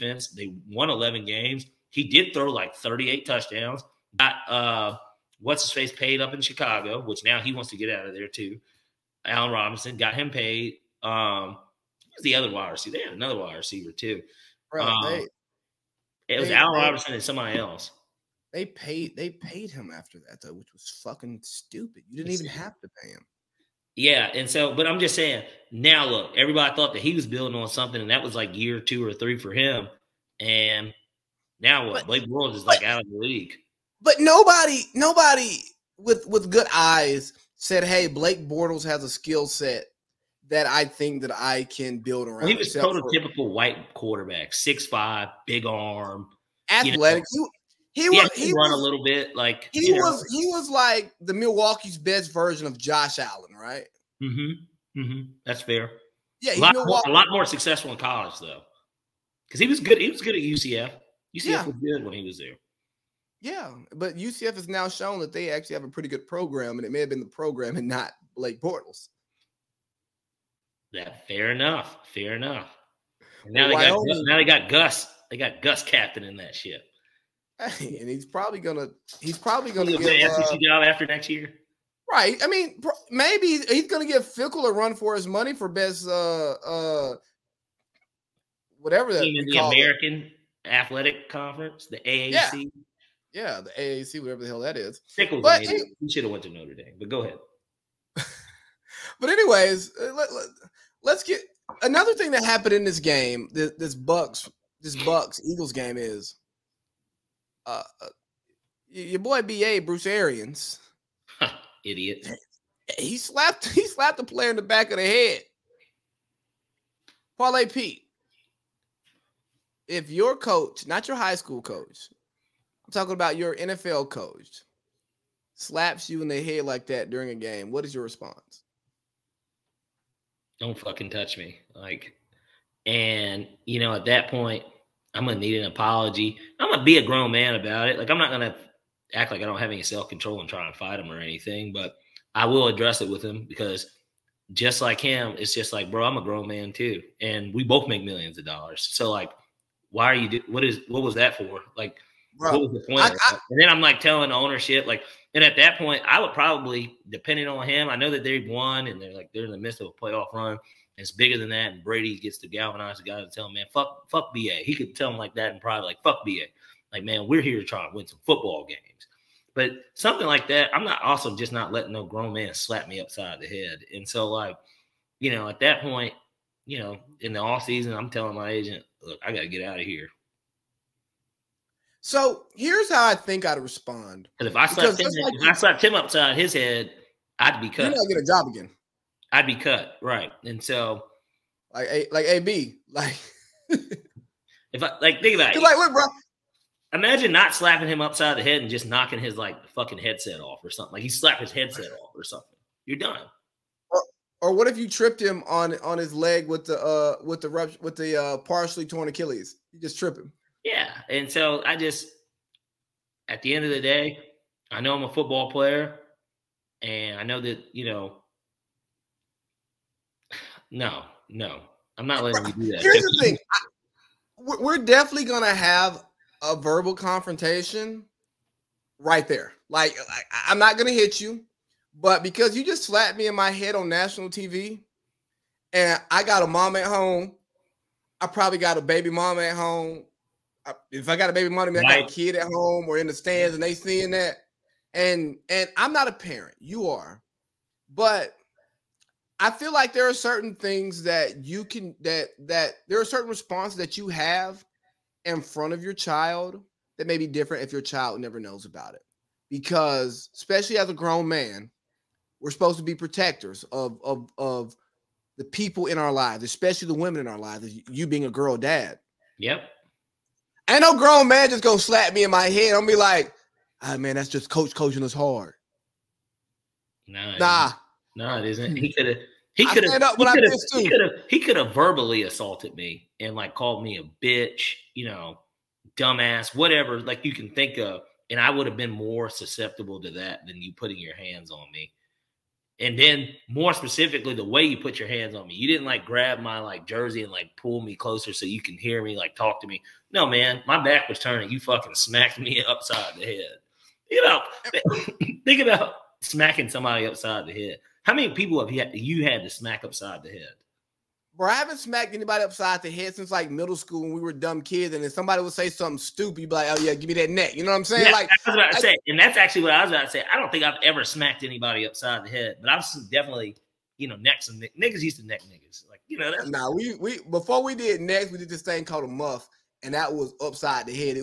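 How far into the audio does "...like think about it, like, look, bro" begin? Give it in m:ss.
3:15.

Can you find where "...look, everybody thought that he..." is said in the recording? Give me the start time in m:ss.
0:26.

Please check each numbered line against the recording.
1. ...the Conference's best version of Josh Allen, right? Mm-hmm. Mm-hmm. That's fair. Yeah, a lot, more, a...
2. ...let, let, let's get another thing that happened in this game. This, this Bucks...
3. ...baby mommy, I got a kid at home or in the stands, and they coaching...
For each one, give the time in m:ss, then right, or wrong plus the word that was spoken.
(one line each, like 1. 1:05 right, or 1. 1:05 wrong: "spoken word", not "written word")
1. 0:51 wrong: "Milwaukee", not "Conference"
2. 1:40 right
3. 4:01 wrong: "seeing", not "coaching".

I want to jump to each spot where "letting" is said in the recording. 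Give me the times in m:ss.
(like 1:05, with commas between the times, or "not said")
2:51, 3:42.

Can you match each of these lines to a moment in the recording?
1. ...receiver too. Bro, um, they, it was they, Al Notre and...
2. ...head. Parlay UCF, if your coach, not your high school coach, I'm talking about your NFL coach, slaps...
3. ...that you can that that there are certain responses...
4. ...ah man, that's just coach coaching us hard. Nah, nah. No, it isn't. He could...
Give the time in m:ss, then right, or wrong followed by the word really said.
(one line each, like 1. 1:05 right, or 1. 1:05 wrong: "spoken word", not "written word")
1. 0:13 wrong: "Robinson", not "Notre"
2. 1:55 wrong: "Pete", not "UCF"
3. 4:11 right
4. 4:33 right.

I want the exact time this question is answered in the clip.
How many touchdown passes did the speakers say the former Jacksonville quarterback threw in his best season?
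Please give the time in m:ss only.
0:02.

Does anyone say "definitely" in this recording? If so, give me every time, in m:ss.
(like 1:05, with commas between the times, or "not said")
3:44, 5:23.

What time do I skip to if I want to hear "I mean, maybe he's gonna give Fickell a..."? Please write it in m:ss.
1:22.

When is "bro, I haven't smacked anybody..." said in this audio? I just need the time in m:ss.
5:11.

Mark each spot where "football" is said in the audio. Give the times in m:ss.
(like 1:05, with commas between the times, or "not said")
2:48, 3:35.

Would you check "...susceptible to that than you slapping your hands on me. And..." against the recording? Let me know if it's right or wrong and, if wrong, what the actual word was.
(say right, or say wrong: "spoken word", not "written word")
wrong: "putting", not "slapping".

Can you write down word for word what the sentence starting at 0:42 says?
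he was prototypical for, white quarterback, six five, big arm, athletic.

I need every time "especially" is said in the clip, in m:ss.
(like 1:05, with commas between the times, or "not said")
4:20, 4:26.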